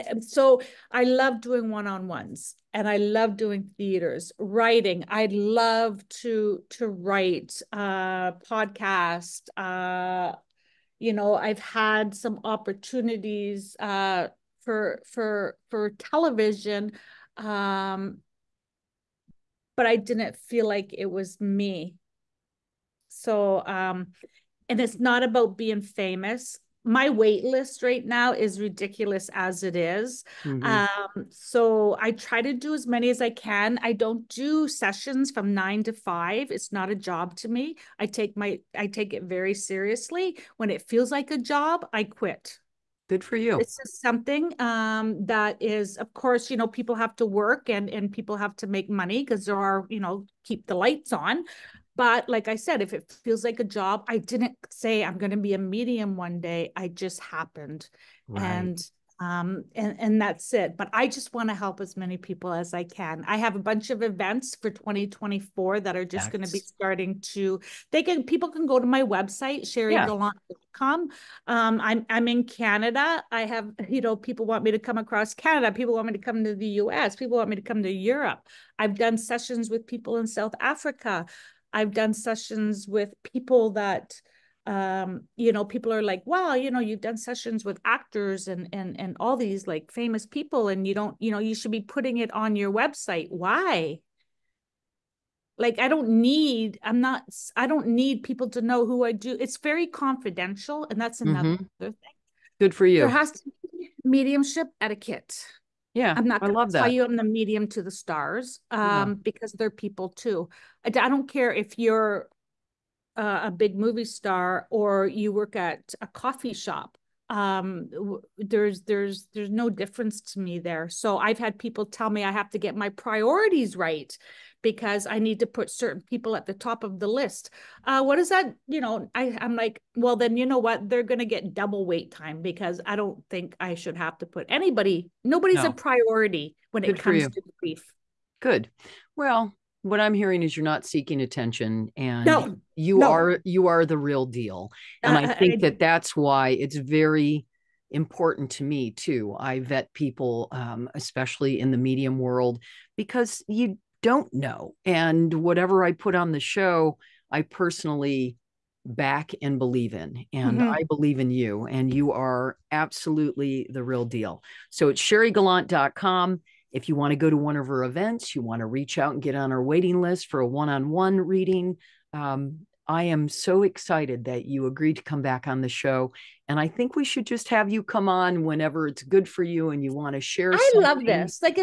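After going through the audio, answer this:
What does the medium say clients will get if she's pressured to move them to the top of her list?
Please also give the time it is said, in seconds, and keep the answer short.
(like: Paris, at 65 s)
double wait time, at 131 s.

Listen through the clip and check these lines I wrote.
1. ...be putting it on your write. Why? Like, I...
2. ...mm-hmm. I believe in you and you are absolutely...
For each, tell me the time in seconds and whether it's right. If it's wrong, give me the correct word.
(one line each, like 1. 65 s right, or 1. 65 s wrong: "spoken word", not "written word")
1. 91 s wrong: "website", not "write"
2. 160 s right.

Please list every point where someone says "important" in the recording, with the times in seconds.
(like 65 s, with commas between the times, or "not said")
147 s.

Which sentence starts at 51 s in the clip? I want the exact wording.
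But like I said, if it feels like a job, I didn't say I'm going to be a medium one day.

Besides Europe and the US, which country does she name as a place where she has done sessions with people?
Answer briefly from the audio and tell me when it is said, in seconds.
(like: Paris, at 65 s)
South Africa, at 80 s.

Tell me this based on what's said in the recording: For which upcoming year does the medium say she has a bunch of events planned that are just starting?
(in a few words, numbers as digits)
2024.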